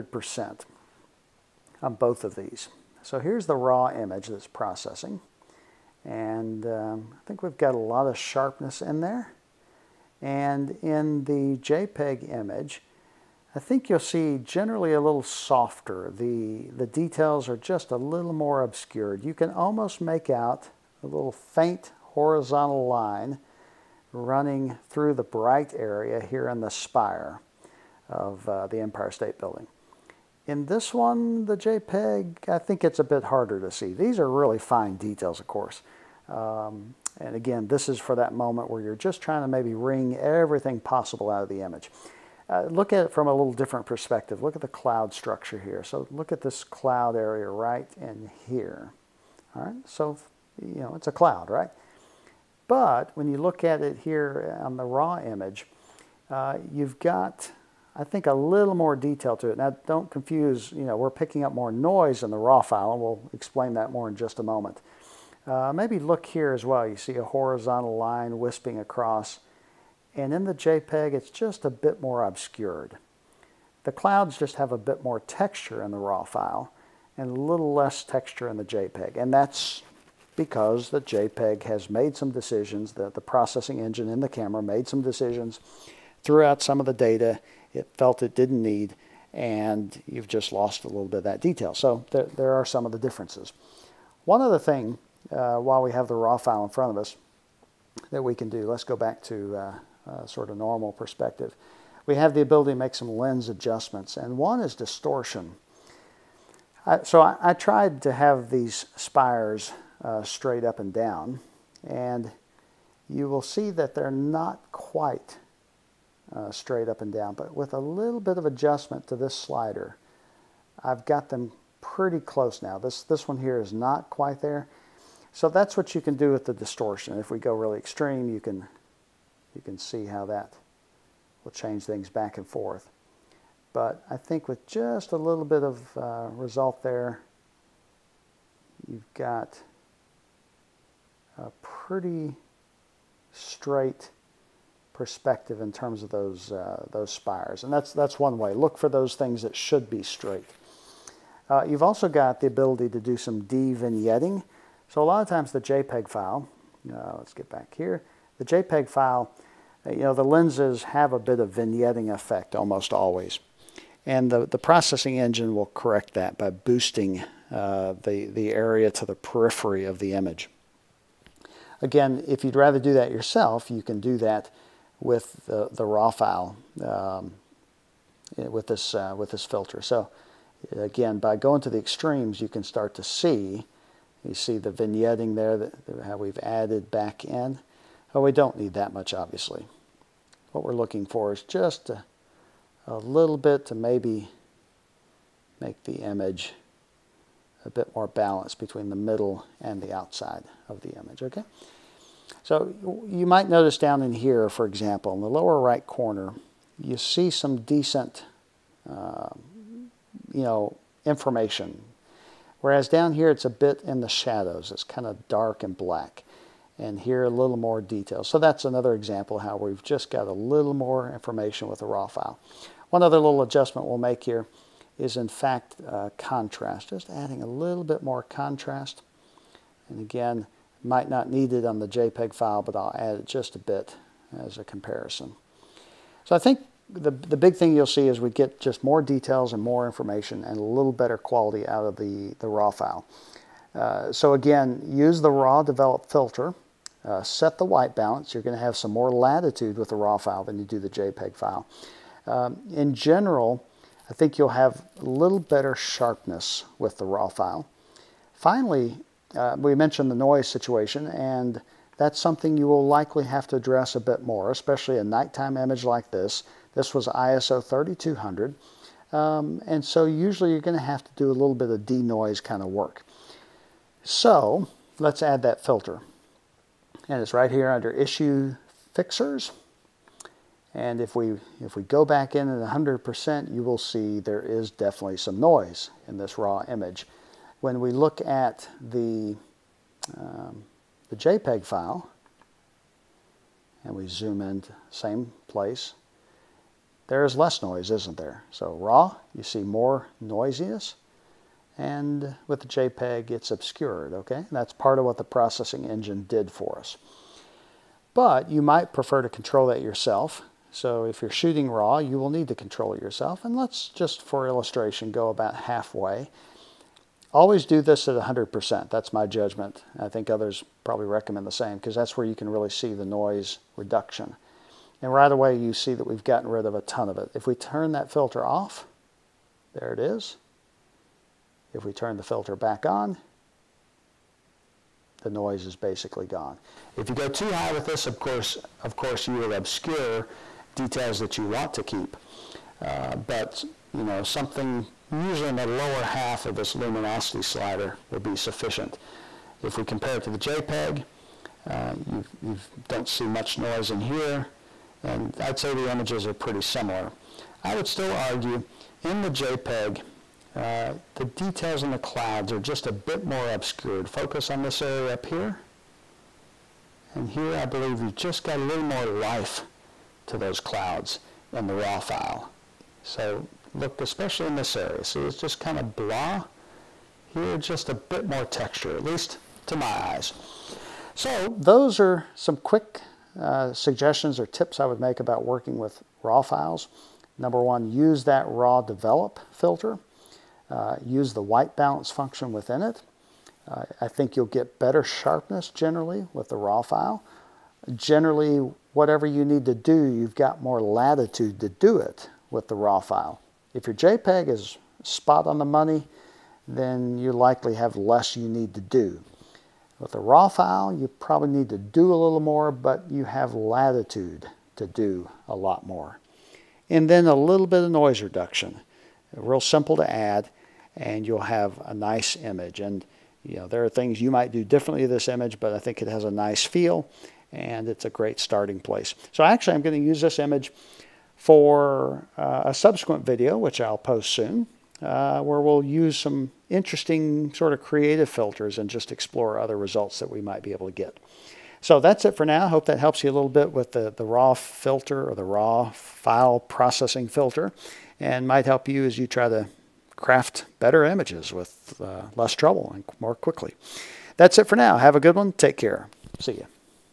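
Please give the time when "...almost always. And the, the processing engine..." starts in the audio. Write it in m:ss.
2:42.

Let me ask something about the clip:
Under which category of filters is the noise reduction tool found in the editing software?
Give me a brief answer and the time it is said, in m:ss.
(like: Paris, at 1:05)
Issue Fixers, at 4:37.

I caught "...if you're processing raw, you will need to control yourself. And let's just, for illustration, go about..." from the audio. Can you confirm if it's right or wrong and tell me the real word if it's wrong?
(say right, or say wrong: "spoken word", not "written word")
wrong: "shooting", not "processing".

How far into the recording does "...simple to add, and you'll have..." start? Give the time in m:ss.
6:59.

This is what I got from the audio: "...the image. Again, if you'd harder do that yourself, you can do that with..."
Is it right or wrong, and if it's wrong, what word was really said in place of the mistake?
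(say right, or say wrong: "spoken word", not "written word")
wrong: "rather", not "harder".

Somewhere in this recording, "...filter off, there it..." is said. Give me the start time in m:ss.
5:28.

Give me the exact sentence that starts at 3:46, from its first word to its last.
Just adding a little bit more contrast.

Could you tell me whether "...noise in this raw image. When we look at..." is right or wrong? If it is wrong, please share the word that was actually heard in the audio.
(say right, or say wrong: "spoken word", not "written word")
right.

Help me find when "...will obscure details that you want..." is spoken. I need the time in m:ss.
5:39.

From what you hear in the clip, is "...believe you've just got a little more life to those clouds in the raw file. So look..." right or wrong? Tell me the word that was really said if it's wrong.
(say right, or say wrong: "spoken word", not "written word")
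right.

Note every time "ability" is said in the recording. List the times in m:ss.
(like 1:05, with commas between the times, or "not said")
1:42, 2:32.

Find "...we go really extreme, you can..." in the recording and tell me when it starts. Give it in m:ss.
2:07.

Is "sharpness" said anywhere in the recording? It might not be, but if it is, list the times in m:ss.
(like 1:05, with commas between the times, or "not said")
0:08, 4:15, 6:35.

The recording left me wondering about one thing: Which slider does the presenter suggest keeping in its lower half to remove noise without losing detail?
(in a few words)
Luminosity slider.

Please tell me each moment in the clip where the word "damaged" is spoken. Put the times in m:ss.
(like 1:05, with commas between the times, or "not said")
not said.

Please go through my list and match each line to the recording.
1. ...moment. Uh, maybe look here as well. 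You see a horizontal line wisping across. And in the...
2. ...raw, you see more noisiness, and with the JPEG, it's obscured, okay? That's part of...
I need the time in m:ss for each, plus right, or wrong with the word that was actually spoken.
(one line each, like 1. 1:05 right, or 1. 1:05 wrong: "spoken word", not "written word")
1. 1:04 right
2. 4:58 right.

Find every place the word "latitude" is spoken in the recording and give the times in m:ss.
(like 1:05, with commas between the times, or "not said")
4:09, 6:40, 6:53.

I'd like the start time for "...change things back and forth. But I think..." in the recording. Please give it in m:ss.
2:11.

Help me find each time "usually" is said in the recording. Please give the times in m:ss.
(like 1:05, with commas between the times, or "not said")
4:30, 5:45.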